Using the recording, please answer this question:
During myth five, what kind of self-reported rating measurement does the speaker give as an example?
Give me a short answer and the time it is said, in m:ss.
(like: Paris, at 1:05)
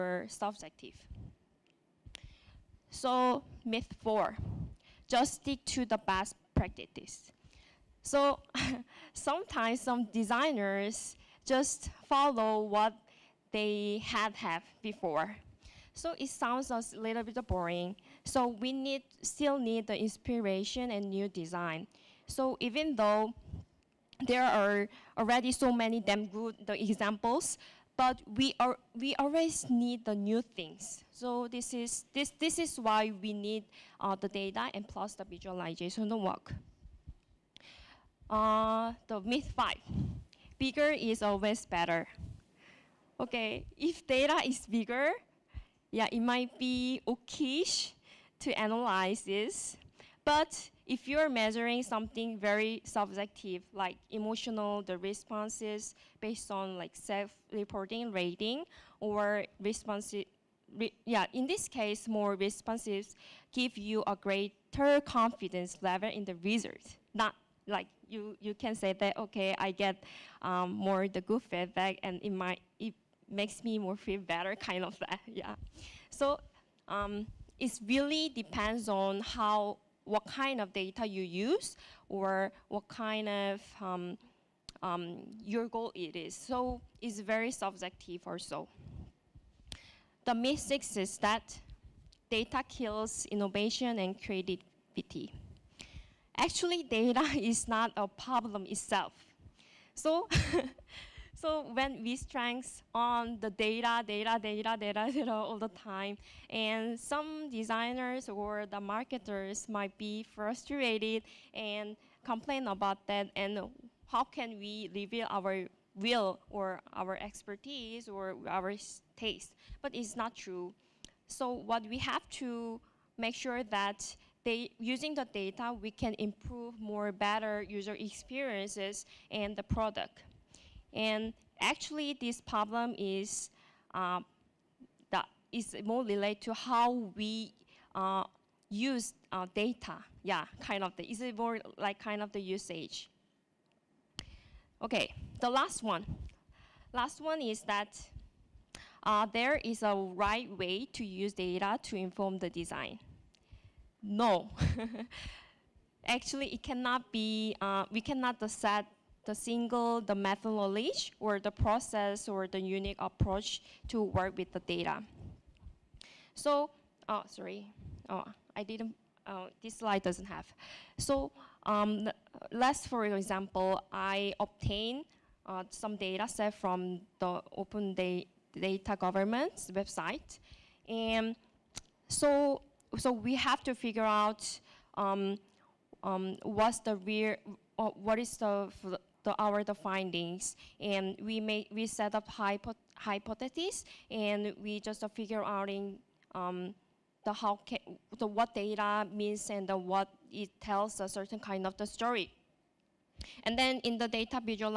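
emotional, at 0:54.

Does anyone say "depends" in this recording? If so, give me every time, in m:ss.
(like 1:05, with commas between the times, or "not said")
1:18.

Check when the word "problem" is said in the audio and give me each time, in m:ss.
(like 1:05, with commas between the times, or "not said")
1:38, 2:12.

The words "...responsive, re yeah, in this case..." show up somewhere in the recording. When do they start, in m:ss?
0:59.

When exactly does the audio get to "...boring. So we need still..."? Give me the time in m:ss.
0:17.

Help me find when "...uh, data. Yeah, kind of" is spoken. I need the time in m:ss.
2:19.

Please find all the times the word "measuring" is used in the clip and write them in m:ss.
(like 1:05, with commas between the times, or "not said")
0:51.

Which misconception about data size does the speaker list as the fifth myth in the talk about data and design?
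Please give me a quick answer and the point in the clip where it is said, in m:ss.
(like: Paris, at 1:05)
Bigger is always better, at 0:40.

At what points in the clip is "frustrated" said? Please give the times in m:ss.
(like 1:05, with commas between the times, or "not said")
1:50.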